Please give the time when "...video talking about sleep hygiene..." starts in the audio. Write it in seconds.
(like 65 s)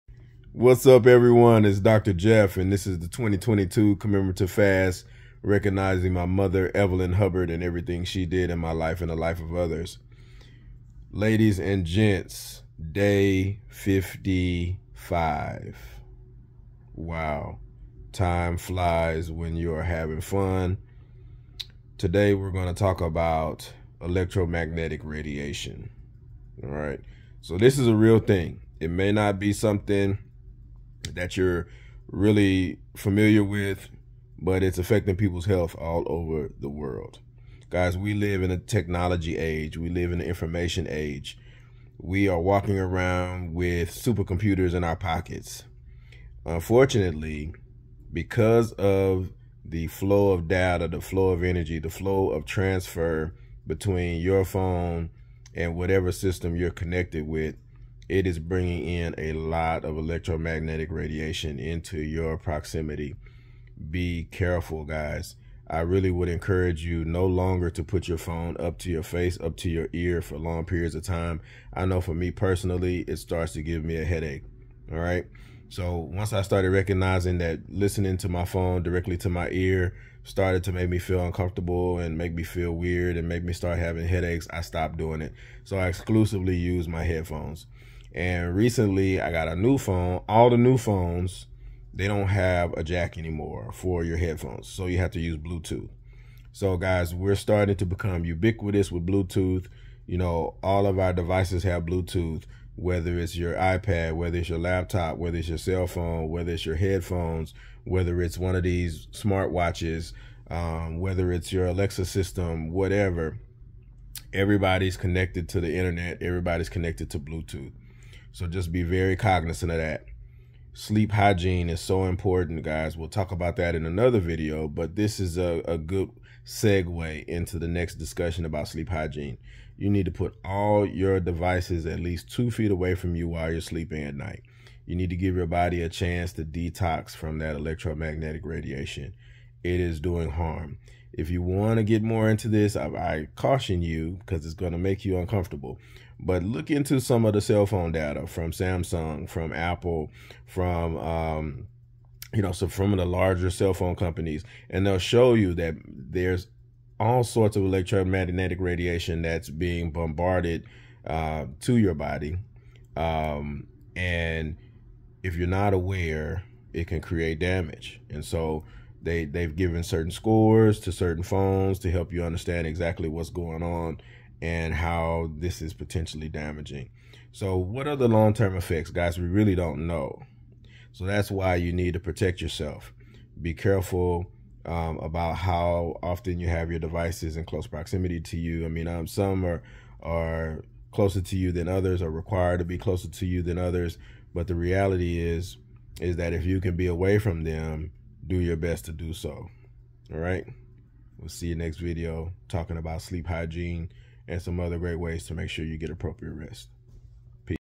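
201 s.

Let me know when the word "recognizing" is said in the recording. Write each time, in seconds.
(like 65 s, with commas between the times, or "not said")
5 s, 76 s.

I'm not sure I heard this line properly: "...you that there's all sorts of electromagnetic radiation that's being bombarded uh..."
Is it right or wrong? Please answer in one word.
right.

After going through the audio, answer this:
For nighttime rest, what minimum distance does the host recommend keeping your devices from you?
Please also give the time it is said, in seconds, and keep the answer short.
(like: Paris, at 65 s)
2 feet, at 132 s.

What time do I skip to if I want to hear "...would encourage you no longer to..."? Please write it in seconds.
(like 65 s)
66 s.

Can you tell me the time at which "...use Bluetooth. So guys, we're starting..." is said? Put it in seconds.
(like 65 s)
95 s.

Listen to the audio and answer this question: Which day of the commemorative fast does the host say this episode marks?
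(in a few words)
Day 55.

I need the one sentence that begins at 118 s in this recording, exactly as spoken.
So just be very cognizant of that sleep hygiene is so important, guys.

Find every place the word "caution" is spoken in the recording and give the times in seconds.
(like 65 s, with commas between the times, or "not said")
143 s.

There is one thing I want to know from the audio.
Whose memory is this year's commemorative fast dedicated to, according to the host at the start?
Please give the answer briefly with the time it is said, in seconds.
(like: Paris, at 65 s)
Evelyn Hubbard, at 6 s.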